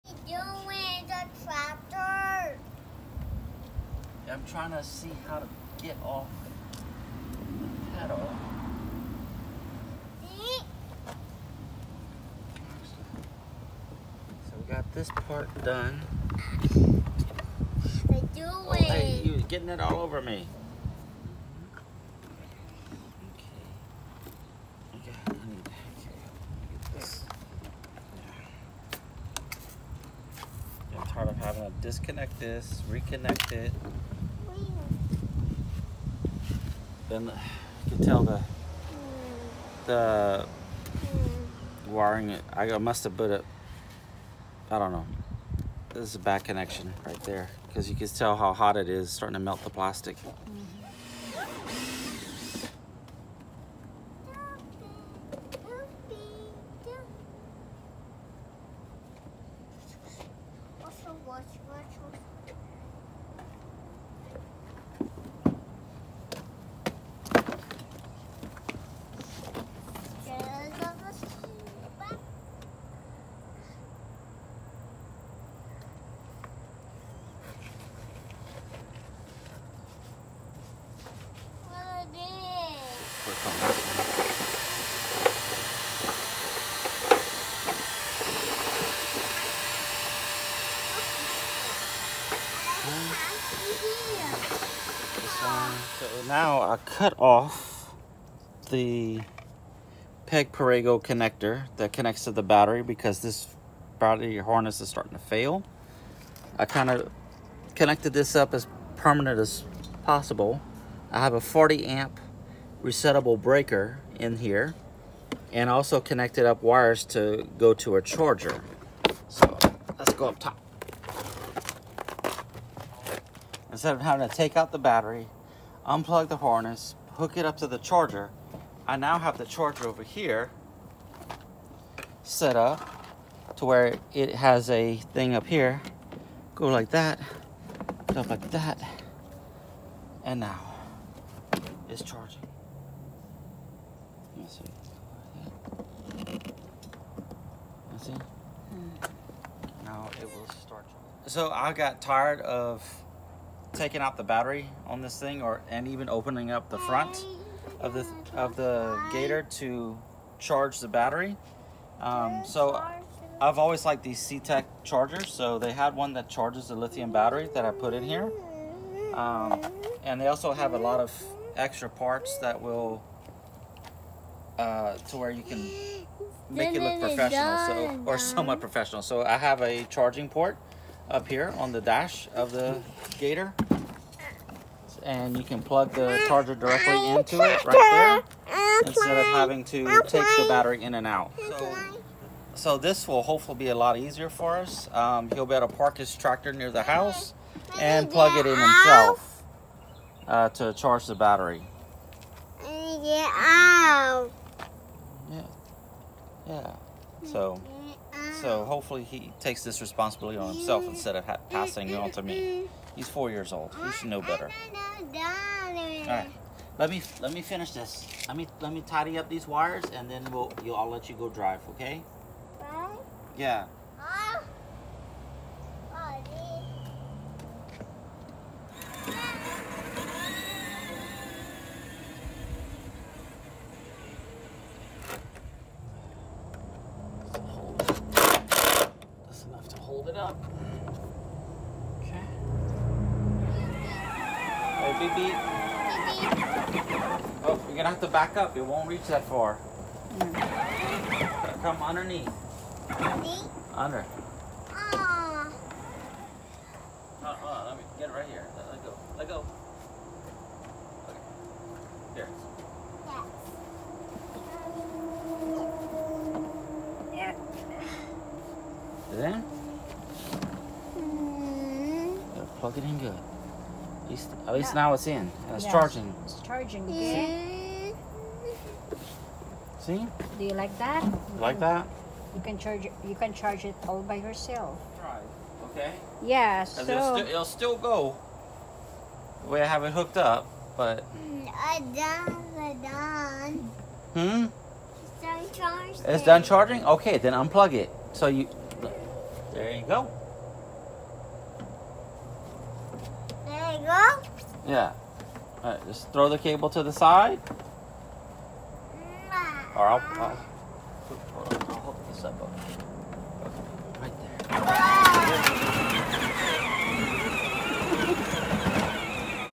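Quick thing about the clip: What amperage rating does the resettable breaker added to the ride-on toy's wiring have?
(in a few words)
40 amp.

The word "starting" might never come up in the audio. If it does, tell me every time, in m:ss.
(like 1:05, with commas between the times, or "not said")
0:49, 1:44.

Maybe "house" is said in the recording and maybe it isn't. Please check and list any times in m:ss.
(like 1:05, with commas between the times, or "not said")
3:16.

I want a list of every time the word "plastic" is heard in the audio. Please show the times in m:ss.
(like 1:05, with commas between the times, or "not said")
0:49.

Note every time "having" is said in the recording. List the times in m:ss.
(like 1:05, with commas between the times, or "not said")
0:31, 2:04, 3:09.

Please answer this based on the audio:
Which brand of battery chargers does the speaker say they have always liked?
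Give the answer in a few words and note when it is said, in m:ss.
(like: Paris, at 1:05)
CTEK, at 2:44.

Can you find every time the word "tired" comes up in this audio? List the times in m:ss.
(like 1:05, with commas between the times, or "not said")
0:31, 2:32.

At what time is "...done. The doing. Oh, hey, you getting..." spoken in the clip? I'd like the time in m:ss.
0:15.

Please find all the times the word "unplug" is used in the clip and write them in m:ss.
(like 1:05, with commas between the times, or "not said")
2:05, 4:57.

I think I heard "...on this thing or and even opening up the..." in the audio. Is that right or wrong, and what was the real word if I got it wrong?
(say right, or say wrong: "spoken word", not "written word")
right.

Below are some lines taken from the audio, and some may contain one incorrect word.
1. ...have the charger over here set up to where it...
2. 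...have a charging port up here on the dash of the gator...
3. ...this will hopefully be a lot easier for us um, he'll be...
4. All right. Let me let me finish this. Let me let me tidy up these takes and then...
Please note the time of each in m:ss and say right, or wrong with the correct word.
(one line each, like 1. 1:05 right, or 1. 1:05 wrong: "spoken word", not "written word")
1. 2:09 right
2. 2:59 right
3. 3:12 right
4. 3:34 wrong: "wires", not "takes".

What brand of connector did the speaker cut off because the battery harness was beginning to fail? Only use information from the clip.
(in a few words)
Peg Perego.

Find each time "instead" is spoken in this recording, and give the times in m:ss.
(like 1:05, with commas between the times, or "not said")
2:03, 3:08, 3:30.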